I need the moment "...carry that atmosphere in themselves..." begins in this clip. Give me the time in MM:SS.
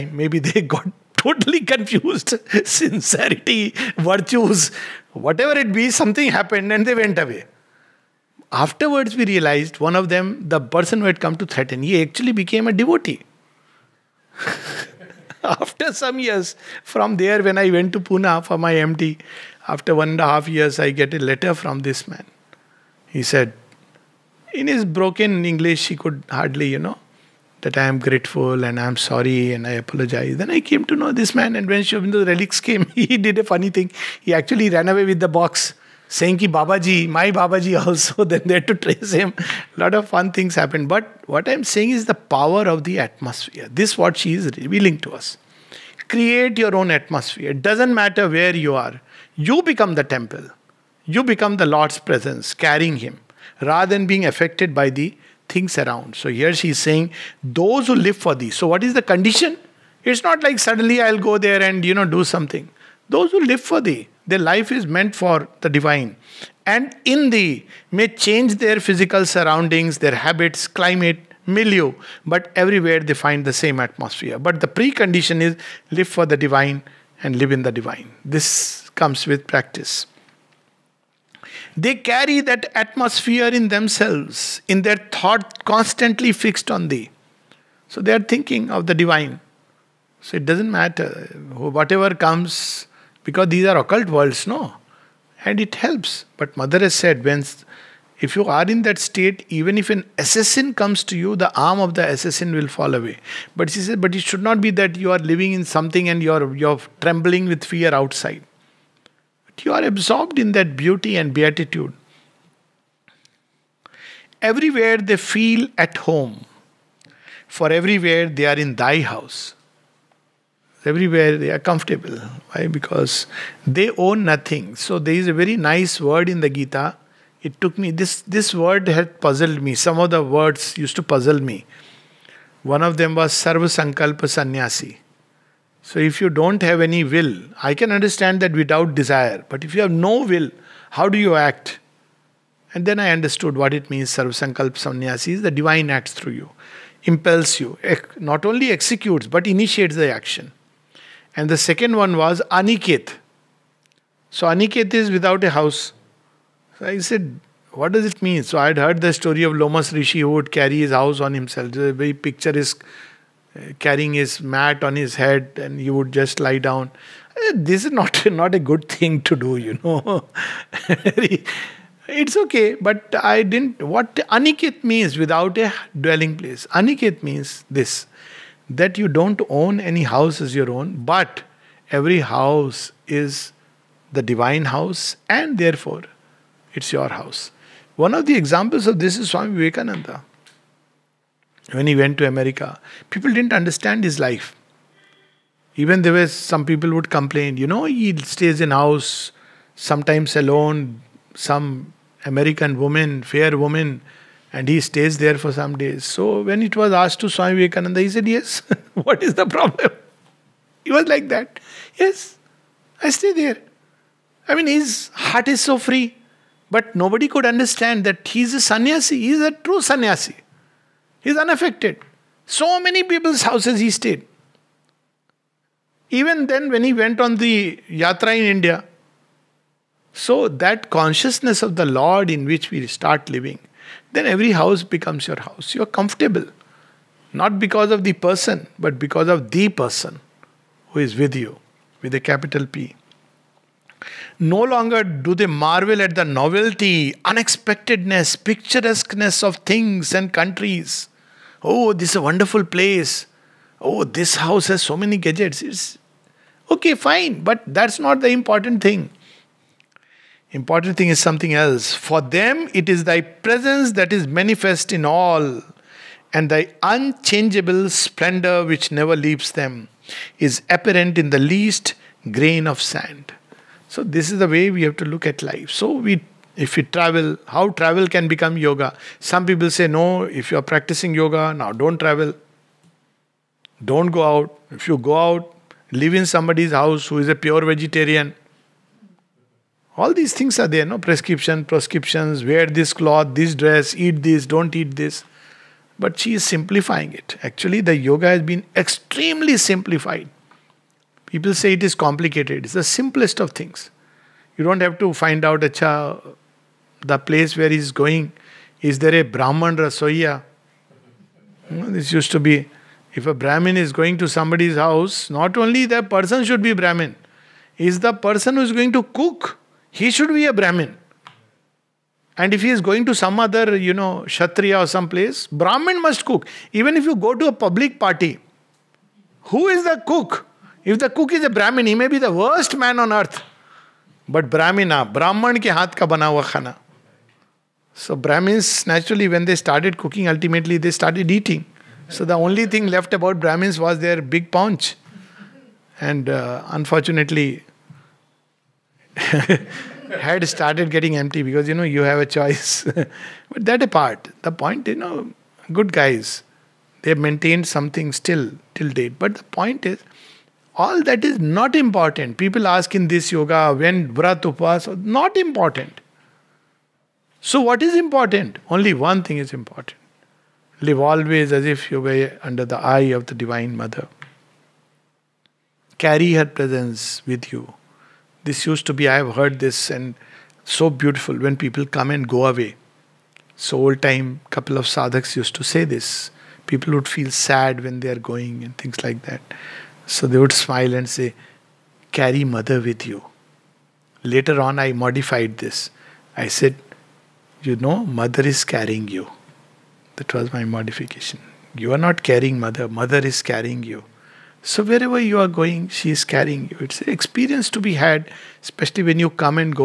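01:21.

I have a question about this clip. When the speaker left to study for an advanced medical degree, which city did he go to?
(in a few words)
Pune.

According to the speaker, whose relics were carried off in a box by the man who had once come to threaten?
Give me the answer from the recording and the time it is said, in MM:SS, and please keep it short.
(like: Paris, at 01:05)
Sri Aurobindo, at 00:31.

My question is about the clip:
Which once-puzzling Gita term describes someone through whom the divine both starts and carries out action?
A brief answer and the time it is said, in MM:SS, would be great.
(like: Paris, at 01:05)
Sarva Sankalpa Sannyasi, at 02:13.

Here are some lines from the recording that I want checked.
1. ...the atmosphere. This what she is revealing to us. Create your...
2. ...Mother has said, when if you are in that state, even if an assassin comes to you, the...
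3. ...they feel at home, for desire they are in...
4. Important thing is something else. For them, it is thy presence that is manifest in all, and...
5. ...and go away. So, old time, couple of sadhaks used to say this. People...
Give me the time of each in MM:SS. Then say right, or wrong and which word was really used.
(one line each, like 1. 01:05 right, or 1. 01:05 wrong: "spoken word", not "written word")
1. 00:42 right
2. 01:36 right
3. 01:54 wrong: "everywhere", not "desire"
4. 04:20 right
5. 06:22 right.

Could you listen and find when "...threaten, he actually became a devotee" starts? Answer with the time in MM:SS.
00:11.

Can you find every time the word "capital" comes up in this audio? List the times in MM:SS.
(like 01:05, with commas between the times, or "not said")
04:02.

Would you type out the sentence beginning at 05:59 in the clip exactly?
But the point is, all that is not important.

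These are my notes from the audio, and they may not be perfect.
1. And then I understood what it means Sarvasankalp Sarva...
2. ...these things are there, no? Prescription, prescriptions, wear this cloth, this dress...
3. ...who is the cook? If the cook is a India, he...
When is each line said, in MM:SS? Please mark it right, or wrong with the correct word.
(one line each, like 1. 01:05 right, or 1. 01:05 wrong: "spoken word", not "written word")
1. 02:22 wrong: "Sannyasi", not "Sarva"
2. 04:50 right
3. 05:29 wrong: "Brahmin", not "India".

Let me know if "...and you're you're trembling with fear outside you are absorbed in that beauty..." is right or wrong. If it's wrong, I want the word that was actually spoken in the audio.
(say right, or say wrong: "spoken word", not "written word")
right.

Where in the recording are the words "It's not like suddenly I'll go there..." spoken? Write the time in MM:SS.
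01:00.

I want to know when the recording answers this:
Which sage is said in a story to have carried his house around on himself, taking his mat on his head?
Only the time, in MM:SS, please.
02:39.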